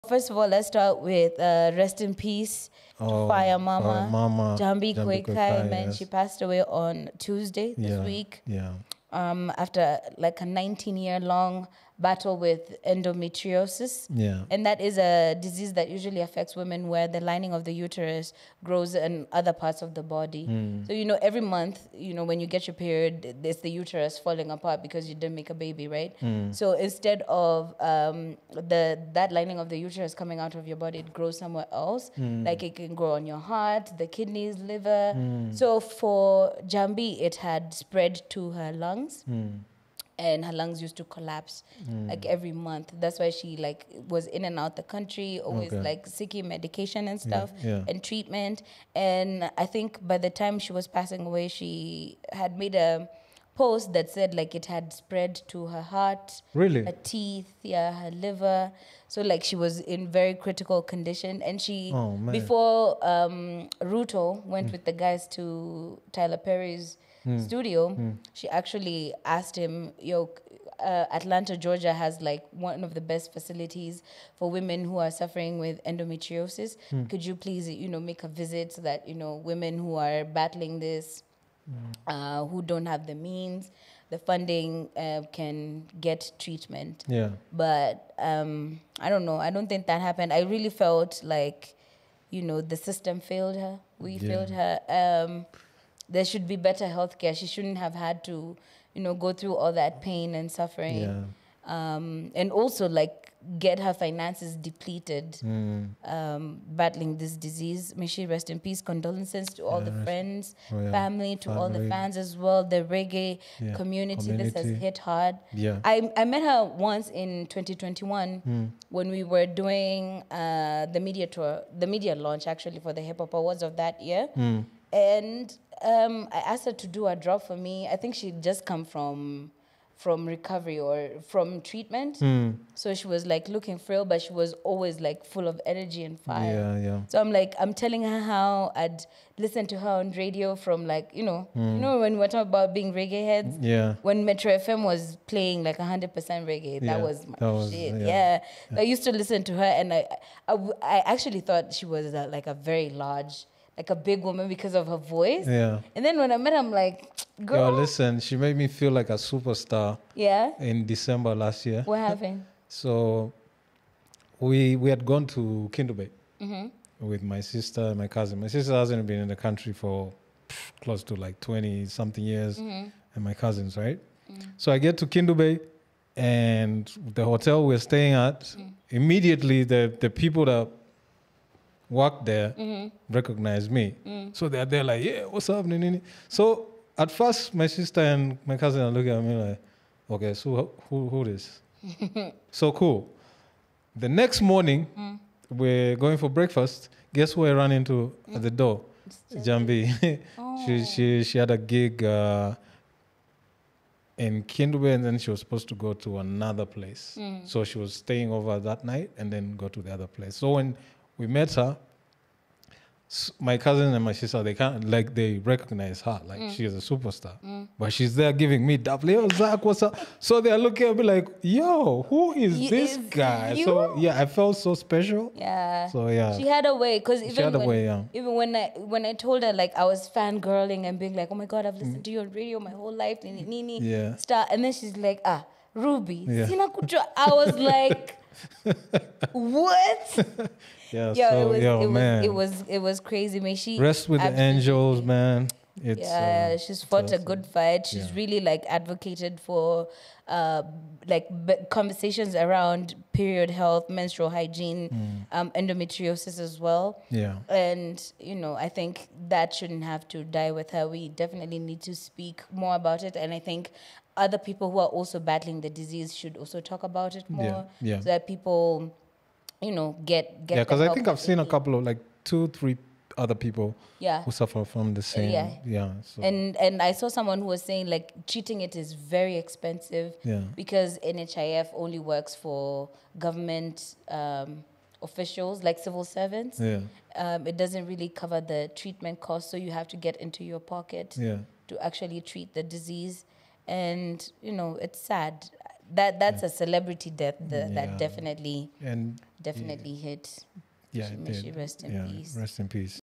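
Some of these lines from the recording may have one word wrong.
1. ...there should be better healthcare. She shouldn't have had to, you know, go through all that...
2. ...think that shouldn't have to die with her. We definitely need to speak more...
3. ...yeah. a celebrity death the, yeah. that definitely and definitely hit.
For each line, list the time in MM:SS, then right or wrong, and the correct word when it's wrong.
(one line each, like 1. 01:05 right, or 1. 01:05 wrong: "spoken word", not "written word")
1. 01:36 right
2. 04:18 right
3. 04:56 right.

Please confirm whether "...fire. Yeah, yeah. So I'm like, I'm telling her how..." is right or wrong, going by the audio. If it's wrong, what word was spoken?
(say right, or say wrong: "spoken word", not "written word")
right.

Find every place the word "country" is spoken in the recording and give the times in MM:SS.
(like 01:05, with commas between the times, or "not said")
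00:44, 02:49.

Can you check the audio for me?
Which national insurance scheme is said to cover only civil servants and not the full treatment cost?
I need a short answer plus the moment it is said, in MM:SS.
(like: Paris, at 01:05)
NHIF, at 04:41.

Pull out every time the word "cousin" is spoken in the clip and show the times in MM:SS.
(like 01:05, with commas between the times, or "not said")
02:48, 02:53, 03:08, 03:33.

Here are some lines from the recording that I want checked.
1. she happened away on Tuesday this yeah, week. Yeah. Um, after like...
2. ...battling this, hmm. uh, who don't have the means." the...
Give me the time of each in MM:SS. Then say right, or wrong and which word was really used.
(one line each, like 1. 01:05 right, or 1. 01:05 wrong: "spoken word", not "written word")
1. 00:05 wrong: "passed", not "happened"
2. 01:20 right.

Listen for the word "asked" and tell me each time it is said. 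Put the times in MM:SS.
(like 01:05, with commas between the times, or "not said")
01:09, 02:06.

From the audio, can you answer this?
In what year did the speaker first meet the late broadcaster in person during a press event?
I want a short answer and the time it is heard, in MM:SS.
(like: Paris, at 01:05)
2021, at 01:57.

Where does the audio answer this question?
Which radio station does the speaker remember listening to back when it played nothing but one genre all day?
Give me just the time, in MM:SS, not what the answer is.
02:24.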